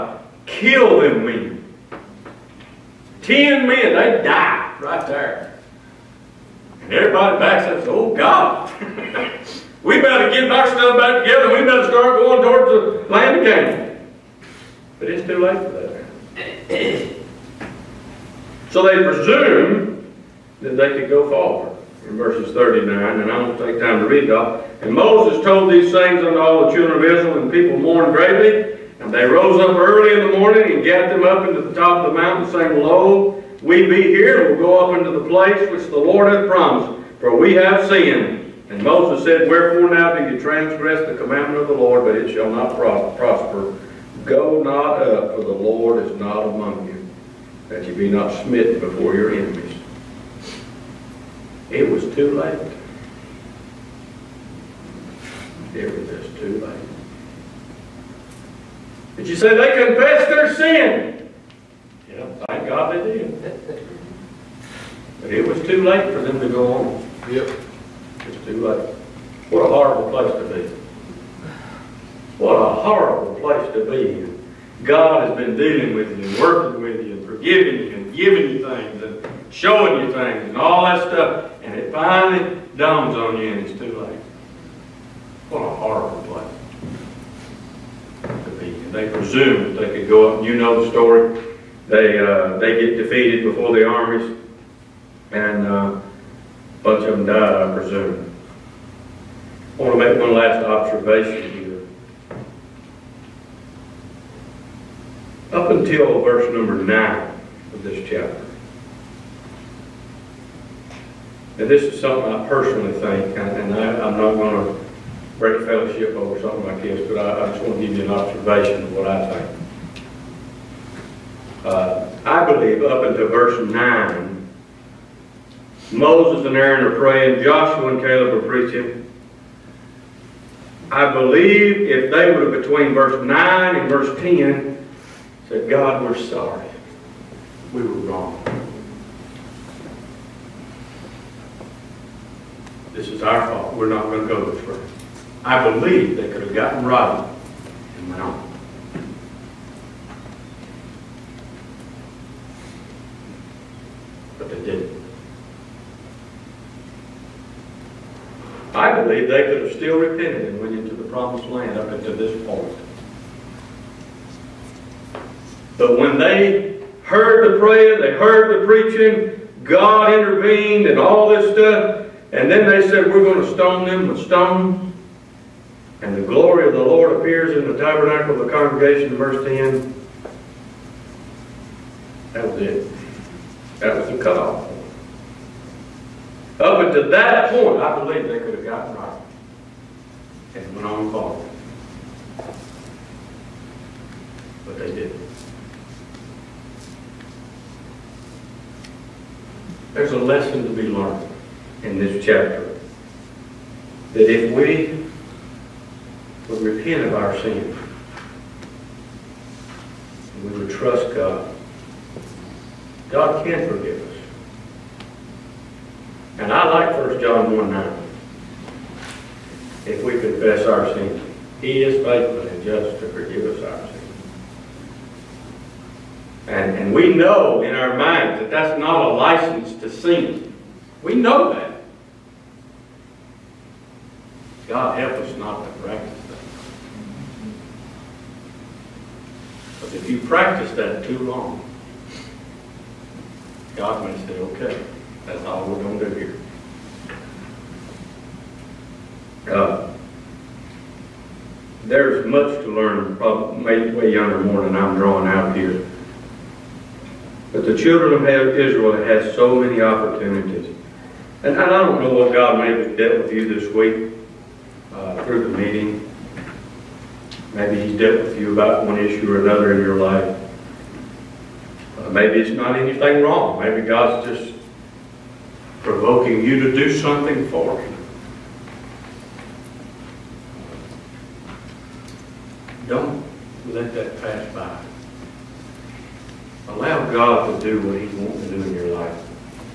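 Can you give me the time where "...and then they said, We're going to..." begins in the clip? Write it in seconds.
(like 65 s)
172 s.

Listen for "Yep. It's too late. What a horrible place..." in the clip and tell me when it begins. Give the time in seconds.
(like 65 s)
67 s.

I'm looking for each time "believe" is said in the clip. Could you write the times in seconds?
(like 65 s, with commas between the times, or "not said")
122 s, 131 s, 145 s, 159 s, 187 s.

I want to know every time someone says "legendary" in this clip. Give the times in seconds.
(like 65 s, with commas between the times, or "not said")
not said.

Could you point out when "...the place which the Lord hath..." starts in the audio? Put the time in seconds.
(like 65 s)
35 s.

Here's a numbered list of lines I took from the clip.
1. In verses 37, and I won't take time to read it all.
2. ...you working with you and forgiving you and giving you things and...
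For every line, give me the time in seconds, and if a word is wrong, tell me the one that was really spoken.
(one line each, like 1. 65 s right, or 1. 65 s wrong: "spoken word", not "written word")
1. 22 s wrong: "39", not "37"
2. 76 s right.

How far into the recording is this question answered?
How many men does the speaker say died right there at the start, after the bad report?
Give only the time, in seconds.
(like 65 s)
3 s.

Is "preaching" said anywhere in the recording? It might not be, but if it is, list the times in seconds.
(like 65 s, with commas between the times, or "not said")
128 s, 168 s.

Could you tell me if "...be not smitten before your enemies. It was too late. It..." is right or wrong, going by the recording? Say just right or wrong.
right.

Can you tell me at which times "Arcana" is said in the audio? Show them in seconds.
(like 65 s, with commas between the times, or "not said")
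not said.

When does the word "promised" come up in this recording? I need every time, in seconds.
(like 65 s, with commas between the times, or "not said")
36 s, 161 s.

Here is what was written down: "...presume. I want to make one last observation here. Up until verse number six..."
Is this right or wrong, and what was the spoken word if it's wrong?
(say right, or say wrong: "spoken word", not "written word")
wrong: "nine", not "six".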